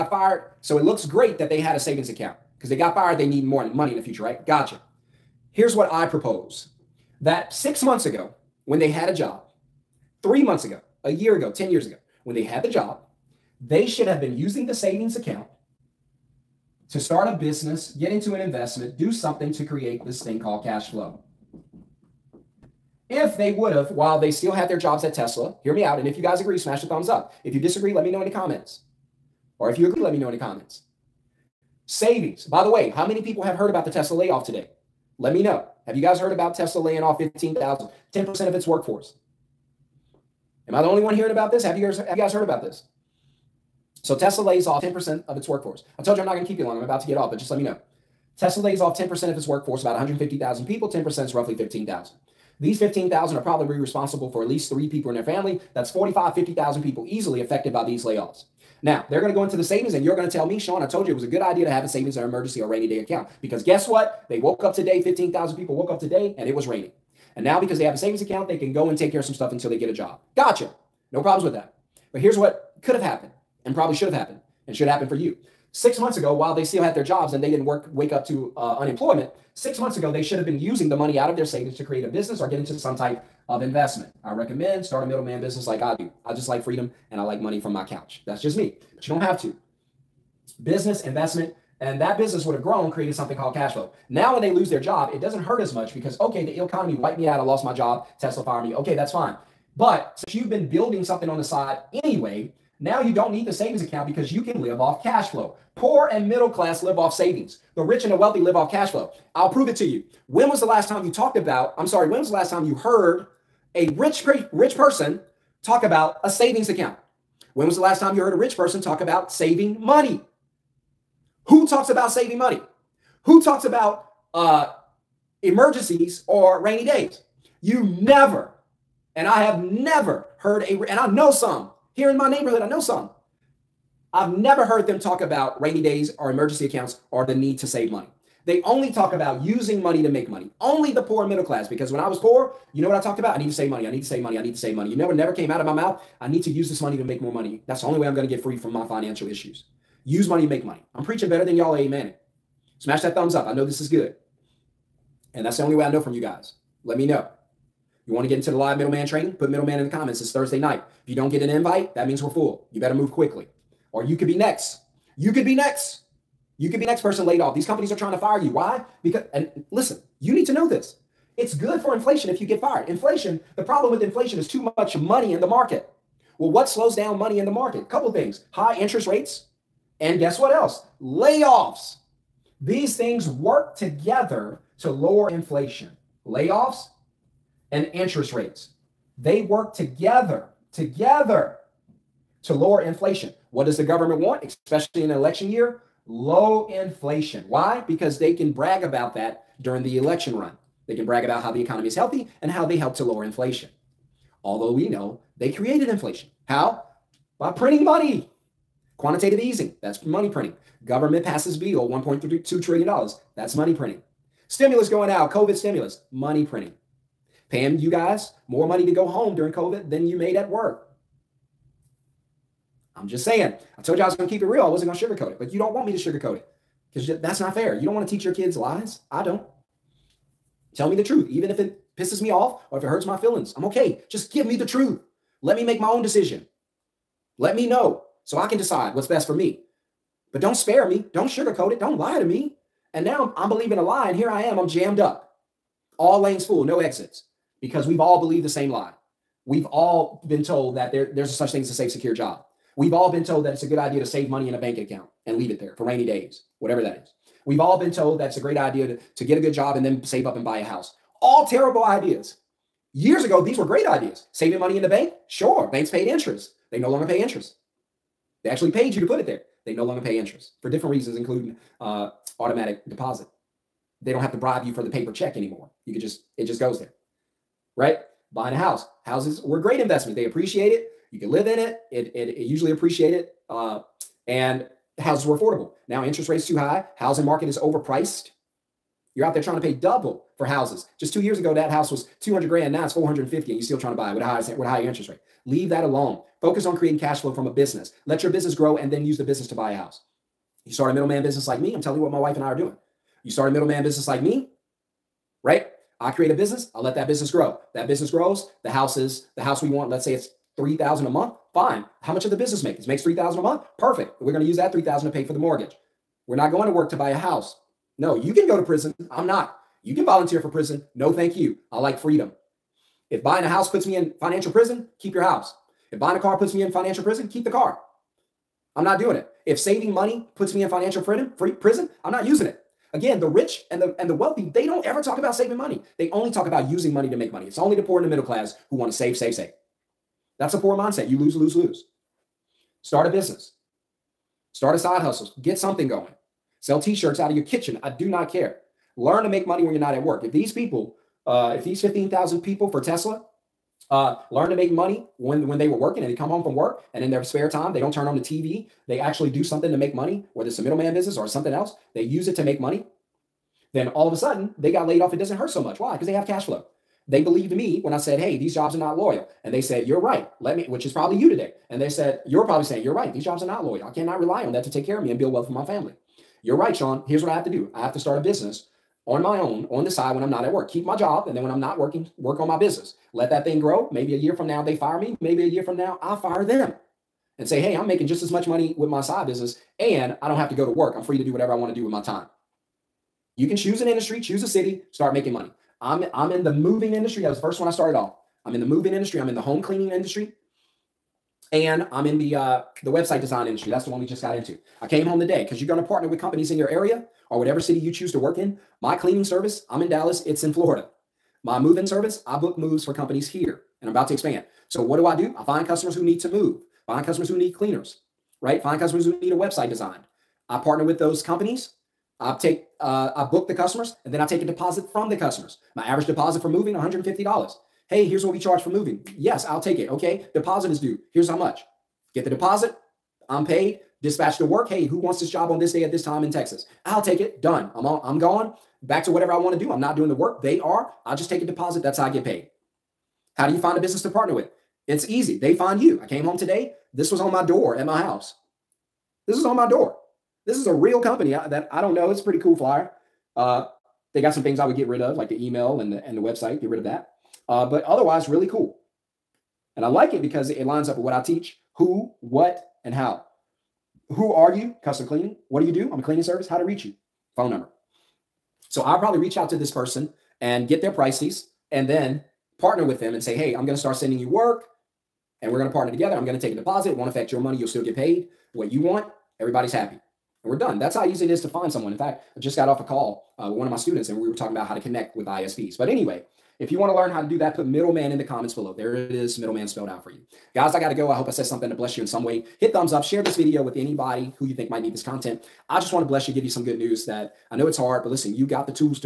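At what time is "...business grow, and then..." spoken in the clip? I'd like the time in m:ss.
4:58.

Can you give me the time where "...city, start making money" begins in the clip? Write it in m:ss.
6:34.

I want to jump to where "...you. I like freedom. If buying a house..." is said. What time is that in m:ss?
5:21.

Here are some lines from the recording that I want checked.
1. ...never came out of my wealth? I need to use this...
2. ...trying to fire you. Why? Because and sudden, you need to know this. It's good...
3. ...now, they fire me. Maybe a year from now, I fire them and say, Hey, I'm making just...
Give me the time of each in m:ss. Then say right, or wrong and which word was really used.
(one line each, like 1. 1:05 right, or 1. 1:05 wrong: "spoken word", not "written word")
1. 2:25 wrong: "mouth", not "wealth"
2. 2:47 wrong: "listen", not "sudden"
3. 6:24 right.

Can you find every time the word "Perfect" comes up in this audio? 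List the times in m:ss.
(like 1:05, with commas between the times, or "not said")
5:13.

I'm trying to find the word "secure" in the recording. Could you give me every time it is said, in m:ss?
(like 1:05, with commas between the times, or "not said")
4:11.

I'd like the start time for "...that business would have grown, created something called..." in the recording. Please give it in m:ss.
1:31.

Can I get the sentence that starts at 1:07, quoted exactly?
And now, because they have a savings account, they can go and take care of some stuff until they get a job.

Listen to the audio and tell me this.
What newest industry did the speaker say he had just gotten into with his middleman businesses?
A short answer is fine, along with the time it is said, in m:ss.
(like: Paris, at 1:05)
Website design, at 6:42.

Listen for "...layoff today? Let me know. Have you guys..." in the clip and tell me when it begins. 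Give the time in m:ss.
0:34.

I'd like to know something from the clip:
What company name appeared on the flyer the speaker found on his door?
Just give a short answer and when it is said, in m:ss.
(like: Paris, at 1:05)
Custom Cleaning, at 7:44.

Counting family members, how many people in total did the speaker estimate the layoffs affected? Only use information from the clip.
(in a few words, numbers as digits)
45,000-50,000.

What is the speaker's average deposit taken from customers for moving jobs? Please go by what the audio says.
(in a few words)
$150.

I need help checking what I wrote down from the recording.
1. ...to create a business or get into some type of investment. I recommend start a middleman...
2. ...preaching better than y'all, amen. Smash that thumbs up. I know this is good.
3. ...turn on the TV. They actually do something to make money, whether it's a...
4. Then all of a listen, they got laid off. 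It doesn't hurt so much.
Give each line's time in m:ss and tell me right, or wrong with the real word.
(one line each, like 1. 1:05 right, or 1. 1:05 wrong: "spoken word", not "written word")
1. 1:21 right
2. 2:31 right
3. 5:57 right
4. 6:03 wrong: "sudden", not "listen".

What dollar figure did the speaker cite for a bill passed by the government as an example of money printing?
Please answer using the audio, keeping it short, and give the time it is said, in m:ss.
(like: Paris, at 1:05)
$1.32 trillion, at 3:31.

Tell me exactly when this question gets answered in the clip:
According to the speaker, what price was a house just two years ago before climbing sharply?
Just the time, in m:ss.
4:52.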